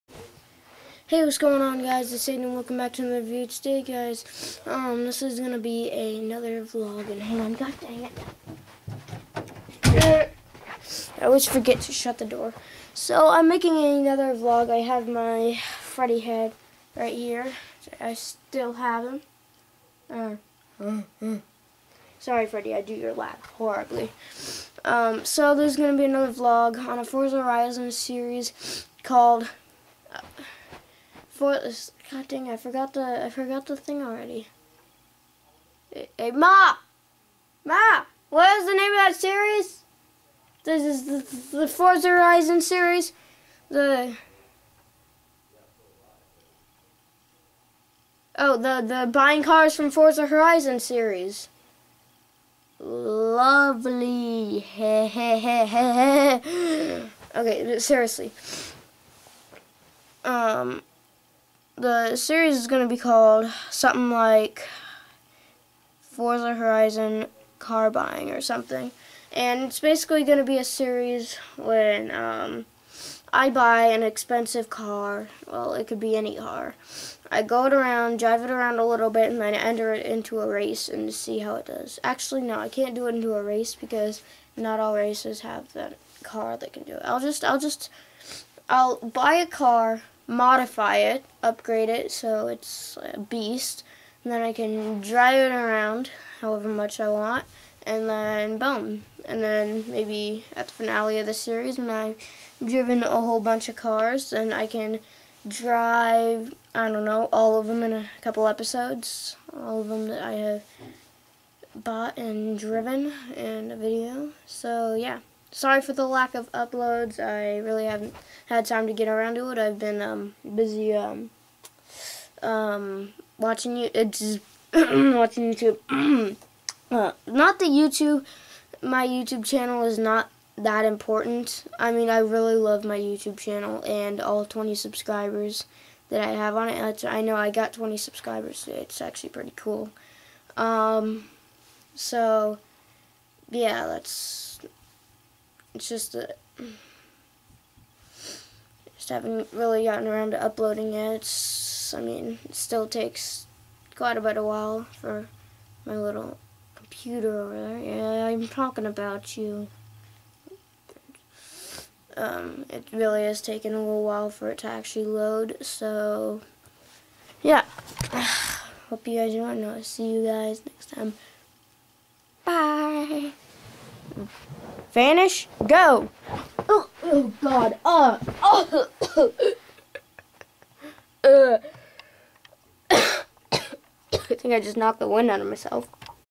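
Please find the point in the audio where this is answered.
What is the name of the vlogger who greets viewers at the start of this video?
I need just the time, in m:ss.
0:02.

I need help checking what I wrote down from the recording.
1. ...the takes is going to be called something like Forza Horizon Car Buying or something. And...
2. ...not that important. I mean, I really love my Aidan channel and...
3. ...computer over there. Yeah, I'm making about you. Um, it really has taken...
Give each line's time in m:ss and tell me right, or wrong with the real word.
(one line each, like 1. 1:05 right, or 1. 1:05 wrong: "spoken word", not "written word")
1. 1:01 wrong: "series", not "takes"
2. 2:09 wrong: "YouTube", not "Aidan"
3. 2:36 wrong: "talking", not "making".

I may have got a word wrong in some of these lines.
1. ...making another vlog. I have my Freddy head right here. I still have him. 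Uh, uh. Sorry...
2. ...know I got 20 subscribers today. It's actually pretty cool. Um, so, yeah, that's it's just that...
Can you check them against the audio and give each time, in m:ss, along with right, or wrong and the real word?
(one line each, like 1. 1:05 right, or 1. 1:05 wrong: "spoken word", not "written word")
1. 0:13 right
2. 2:17 right.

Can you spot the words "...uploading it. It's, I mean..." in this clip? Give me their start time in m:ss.
2:30.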